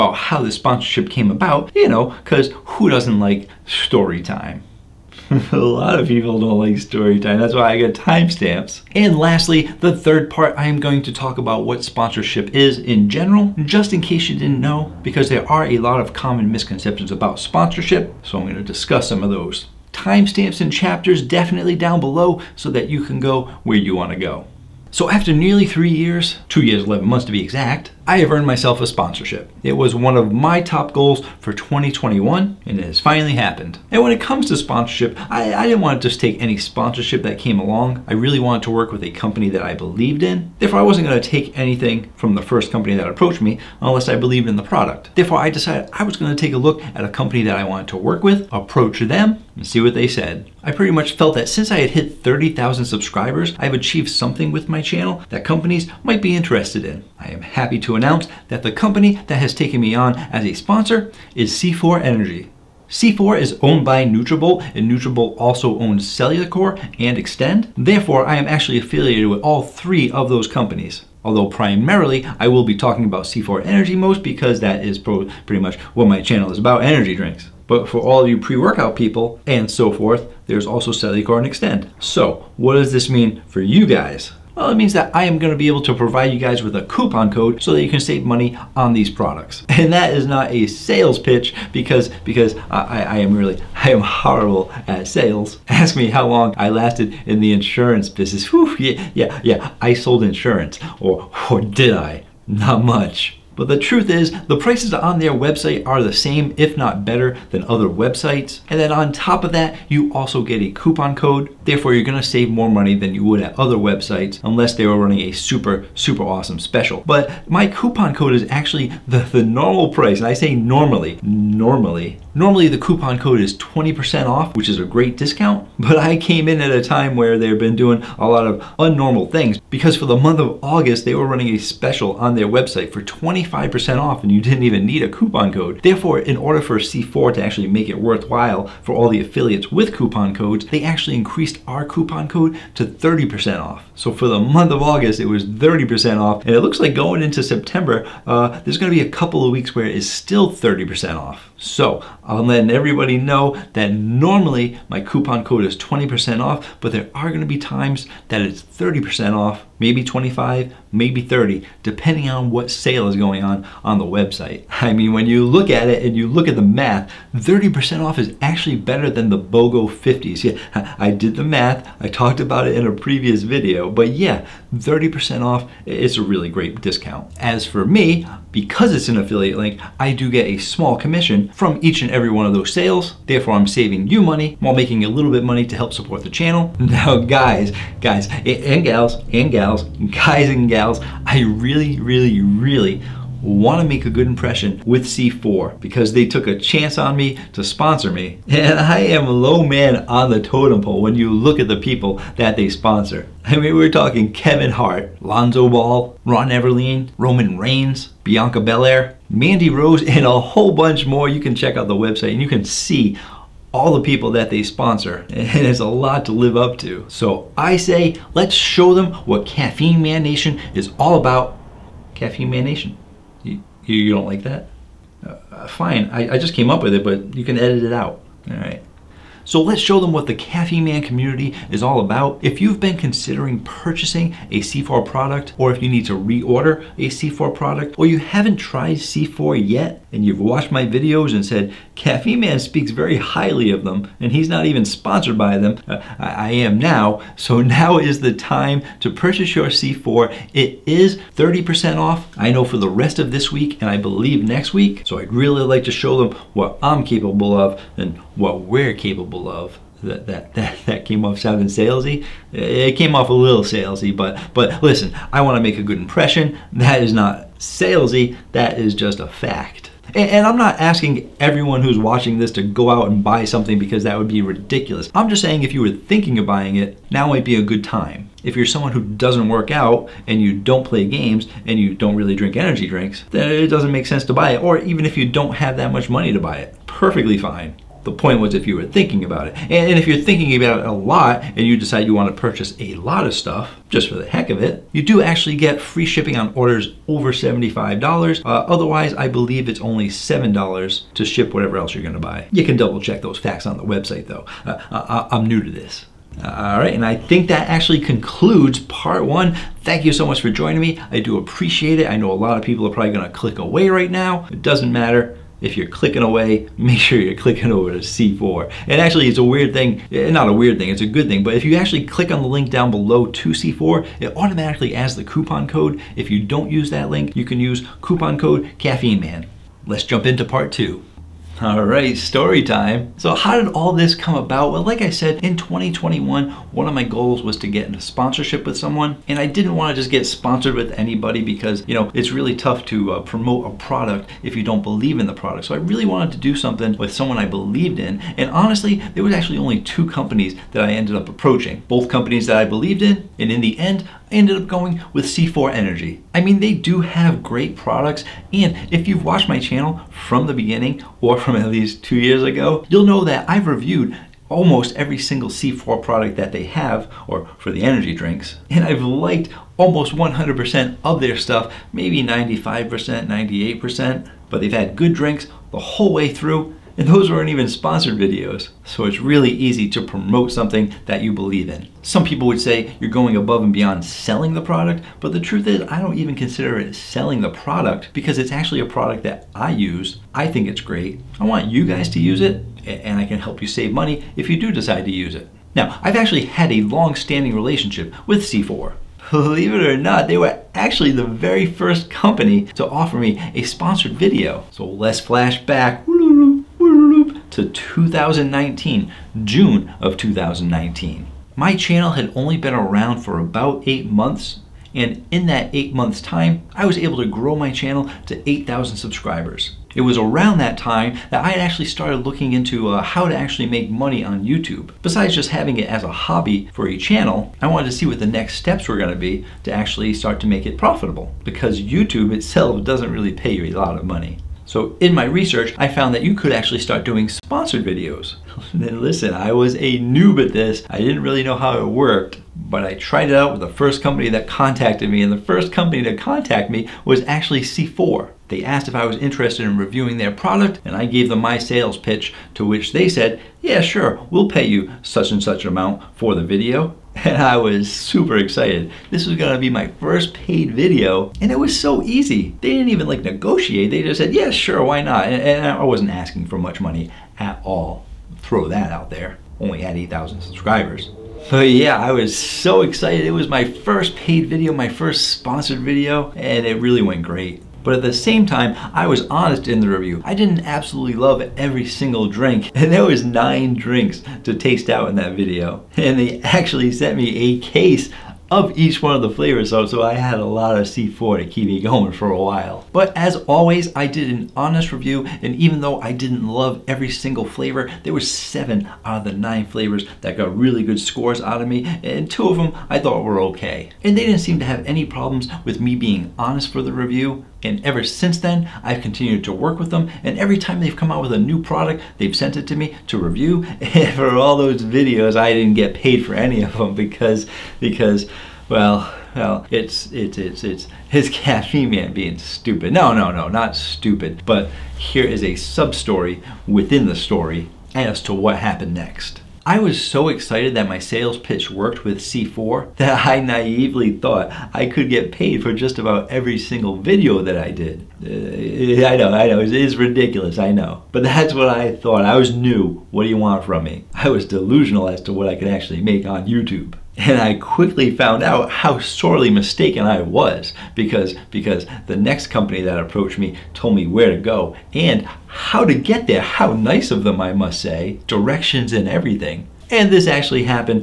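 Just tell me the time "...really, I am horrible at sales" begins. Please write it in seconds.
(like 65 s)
93 s.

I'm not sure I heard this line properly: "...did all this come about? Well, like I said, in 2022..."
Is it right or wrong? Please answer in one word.
wrong.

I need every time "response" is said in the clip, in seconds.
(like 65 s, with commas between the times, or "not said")
not said.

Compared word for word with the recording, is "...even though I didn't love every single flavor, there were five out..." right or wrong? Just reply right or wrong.
wrong.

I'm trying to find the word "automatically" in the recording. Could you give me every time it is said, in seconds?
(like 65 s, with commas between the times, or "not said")
324 s.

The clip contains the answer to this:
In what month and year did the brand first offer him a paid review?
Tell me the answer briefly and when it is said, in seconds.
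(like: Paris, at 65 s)
June 2019, at 409 s.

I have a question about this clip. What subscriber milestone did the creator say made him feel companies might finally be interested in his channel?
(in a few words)
30,000.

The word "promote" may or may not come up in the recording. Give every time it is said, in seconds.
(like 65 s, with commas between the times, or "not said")
343 s, 380 s.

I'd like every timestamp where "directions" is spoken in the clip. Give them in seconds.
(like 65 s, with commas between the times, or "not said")
558 s.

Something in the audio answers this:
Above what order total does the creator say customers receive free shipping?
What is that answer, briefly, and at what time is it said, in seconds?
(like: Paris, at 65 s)
$75, at 297 s.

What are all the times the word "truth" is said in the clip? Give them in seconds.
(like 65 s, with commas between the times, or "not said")
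103 s, 385 s.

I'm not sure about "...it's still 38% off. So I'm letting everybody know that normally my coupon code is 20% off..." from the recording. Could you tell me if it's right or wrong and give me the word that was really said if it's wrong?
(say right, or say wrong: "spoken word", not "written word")
wrong: "30", not "38".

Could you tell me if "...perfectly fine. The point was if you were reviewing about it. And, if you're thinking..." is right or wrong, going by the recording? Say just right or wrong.
wrong.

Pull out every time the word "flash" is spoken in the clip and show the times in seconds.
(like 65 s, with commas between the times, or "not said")
405 s.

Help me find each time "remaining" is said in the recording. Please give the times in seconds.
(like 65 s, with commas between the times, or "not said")
not said.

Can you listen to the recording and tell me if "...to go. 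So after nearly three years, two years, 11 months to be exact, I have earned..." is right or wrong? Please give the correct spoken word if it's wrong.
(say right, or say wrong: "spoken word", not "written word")
right.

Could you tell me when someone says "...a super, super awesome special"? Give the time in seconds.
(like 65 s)
115 s.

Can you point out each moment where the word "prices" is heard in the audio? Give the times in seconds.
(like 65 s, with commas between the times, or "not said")
104 s, 119 s.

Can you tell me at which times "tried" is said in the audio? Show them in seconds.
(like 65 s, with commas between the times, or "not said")
238 s, 442 s.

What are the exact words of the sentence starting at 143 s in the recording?
So for the month of August, it was 30% off.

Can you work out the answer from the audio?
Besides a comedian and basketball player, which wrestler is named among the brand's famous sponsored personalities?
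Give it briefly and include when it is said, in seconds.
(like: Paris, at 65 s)
Roman Reigns, at 207 s.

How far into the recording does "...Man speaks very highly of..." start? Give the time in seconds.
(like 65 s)
242 s.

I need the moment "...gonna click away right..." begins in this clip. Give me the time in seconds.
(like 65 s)
313 s.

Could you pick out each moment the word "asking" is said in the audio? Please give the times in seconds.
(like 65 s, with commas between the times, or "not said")
270 s, 466 s.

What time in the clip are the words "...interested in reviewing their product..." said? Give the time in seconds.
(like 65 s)
449 s.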